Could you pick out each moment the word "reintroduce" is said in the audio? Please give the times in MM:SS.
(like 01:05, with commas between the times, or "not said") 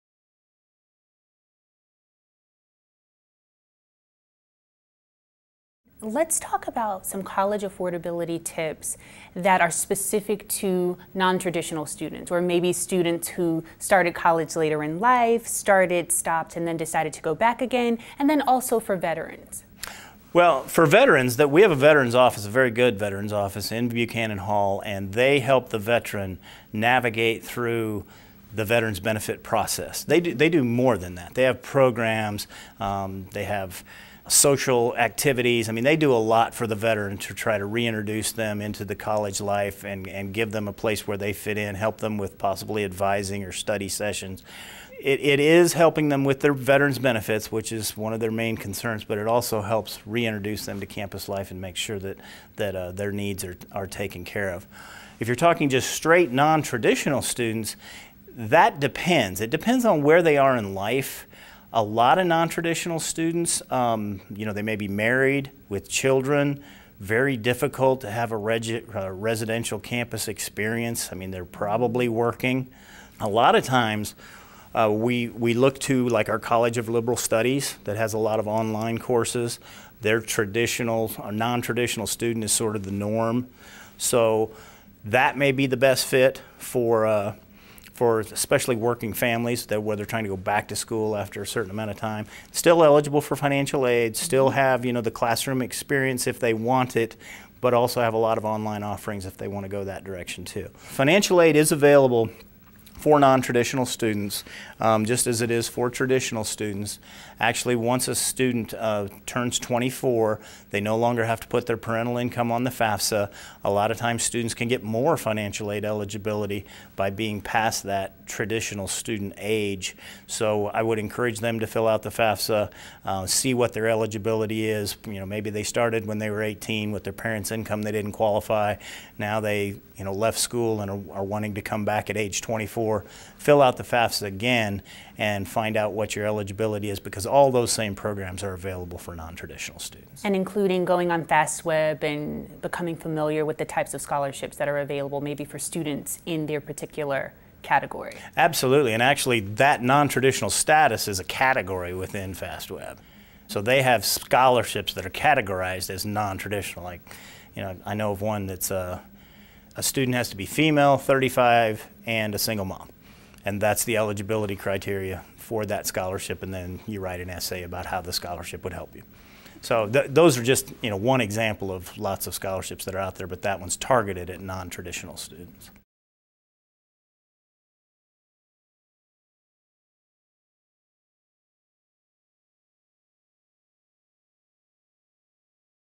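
00:37, 00:50.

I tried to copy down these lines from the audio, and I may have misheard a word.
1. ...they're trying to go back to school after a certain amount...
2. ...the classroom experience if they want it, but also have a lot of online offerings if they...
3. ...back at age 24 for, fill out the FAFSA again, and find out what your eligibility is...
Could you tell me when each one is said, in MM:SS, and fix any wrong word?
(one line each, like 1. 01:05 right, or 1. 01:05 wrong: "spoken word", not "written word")
1. 01:29 right
2. 01:35 right
3. 02:11 right.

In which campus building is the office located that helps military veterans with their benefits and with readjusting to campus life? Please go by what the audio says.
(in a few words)
Buchanan Hall.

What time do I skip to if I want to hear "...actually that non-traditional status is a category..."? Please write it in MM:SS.
02:29.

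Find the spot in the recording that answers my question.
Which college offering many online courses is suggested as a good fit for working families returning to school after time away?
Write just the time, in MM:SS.
01:16.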